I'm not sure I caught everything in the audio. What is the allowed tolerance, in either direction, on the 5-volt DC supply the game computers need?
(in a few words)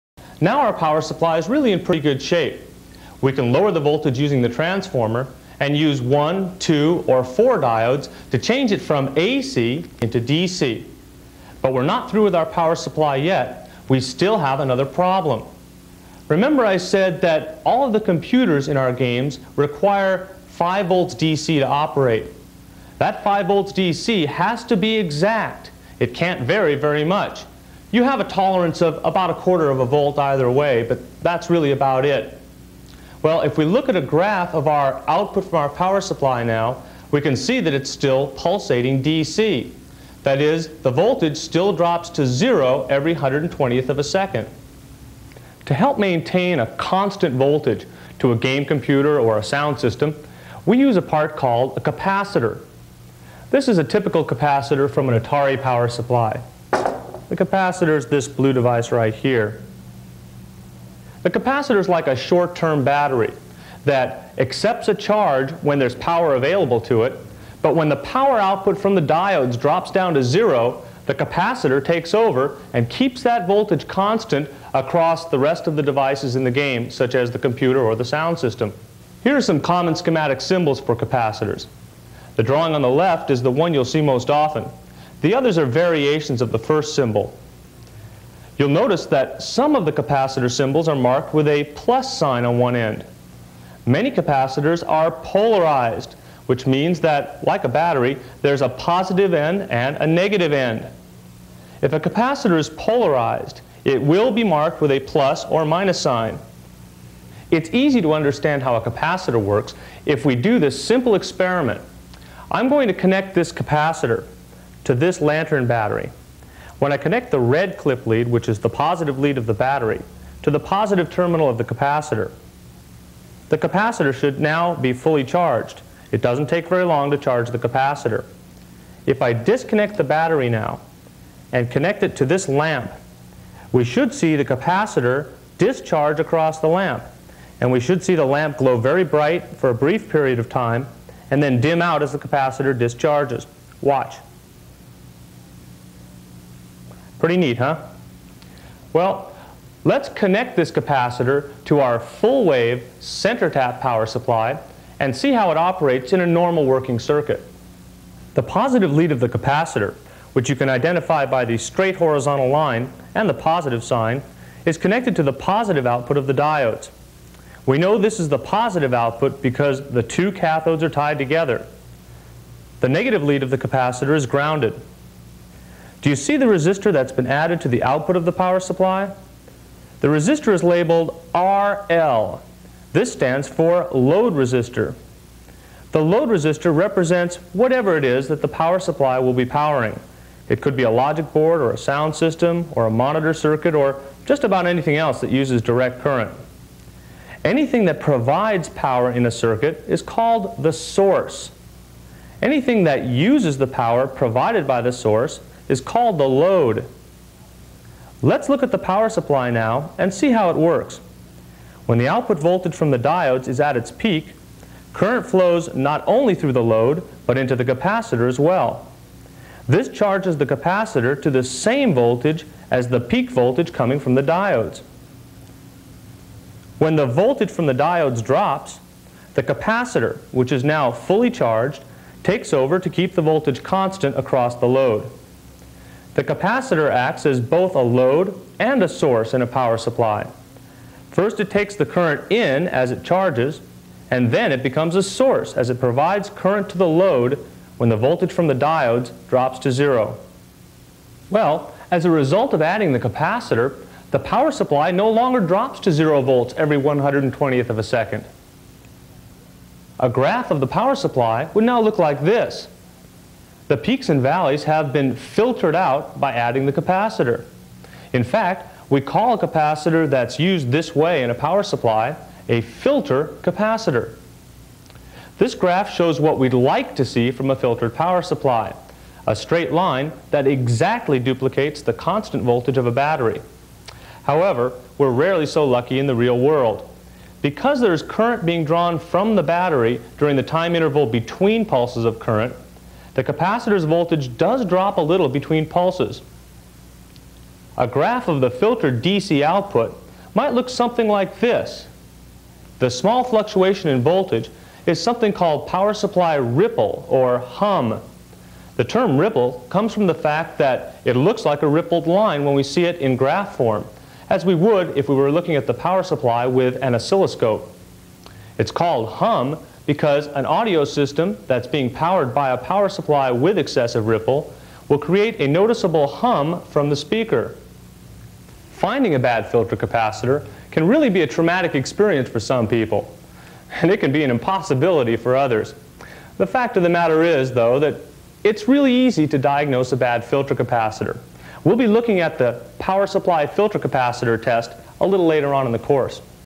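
a quarter of a volt.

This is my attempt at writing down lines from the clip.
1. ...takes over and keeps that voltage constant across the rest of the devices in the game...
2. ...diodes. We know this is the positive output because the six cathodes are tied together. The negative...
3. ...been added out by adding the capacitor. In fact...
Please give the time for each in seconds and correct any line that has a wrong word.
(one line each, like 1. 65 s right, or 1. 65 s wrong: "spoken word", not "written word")
1. 71 s right
2. 166 s wrong: "two", not "six"
3. 264 s wrong: "filtered", not "added".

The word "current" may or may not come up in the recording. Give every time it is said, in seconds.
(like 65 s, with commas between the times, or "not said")
196 s, 214 s, 241 s, 246 s, 288 s, 292 s.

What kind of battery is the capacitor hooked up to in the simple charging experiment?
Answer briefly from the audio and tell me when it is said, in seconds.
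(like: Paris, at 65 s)
lantern battery, at 115 s.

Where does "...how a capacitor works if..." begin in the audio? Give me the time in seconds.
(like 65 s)
108 s.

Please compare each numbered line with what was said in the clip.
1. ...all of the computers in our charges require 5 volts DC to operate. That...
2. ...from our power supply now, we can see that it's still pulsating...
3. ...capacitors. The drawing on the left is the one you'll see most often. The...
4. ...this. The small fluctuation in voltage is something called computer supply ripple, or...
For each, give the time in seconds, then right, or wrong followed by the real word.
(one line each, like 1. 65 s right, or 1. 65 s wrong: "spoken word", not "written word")
1. 17 s wrong: "games", not "charges"
2. 35 s right
3. 80 s right
4. 301 s wrong: "power", not "computer".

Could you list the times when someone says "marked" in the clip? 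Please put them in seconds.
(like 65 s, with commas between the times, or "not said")
90 s, 104 s.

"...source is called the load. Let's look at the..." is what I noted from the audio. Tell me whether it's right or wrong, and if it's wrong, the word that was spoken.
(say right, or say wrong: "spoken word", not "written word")
right.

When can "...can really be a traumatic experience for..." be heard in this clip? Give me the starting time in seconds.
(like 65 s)
330 s.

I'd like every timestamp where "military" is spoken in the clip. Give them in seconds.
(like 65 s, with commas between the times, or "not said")
not said.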